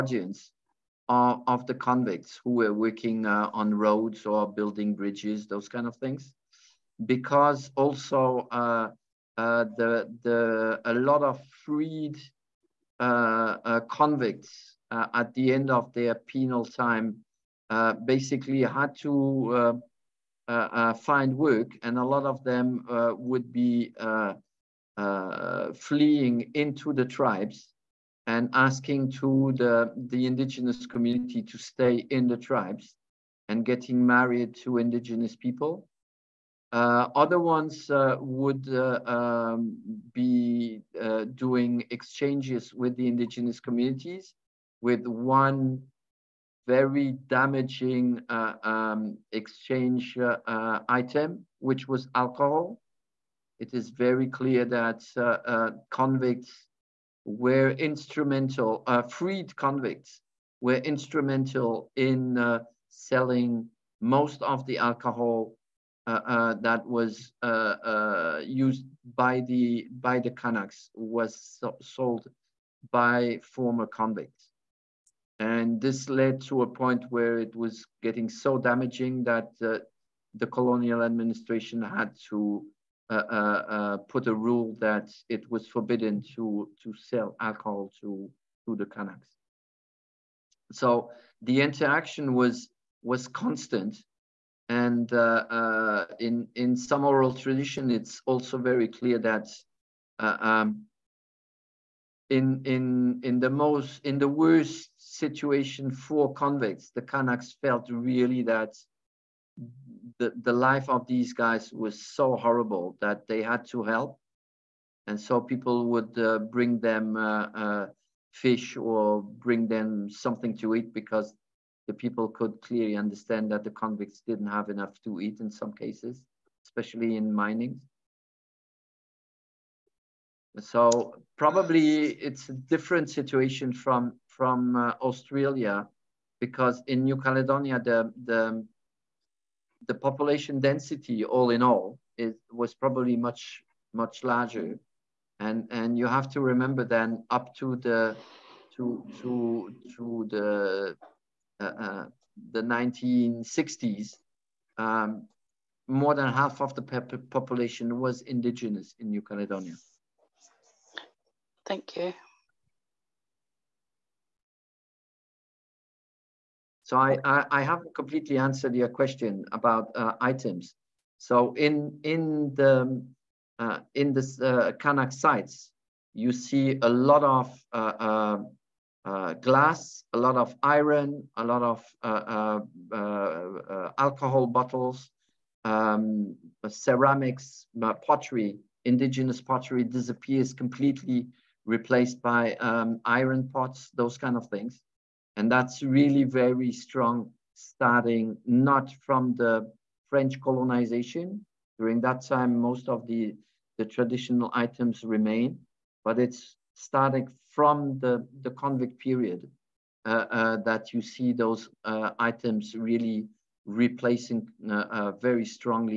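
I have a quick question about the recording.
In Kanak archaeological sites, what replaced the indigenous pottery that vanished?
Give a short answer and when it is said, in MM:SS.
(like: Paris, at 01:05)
iron pots, at 03:13.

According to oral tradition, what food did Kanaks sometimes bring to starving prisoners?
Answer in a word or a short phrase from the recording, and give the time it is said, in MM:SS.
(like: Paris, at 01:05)
fish, at 01:58.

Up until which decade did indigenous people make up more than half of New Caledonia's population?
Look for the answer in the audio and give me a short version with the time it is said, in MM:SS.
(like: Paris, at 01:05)
1960s, at 02:32.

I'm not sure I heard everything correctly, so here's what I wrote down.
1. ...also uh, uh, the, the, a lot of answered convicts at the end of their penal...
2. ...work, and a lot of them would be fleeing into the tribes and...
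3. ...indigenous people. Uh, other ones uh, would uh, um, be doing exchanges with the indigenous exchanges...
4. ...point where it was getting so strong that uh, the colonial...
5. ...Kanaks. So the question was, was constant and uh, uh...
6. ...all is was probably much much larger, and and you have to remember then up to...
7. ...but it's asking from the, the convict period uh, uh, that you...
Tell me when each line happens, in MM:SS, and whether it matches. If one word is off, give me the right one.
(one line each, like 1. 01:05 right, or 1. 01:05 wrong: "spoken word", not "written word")
1. 00:07 wrong: "freed", not "answered"
2. 00:21 right
3. 00:34 wrong: "communities", not "exchanges"
4. 01:16 wrong: "damaging", not "strong"
5. 01:28 wrong: "interaction", not "question"
6. 02:21 right
7. 03:26 wrong: "starting", not "asking".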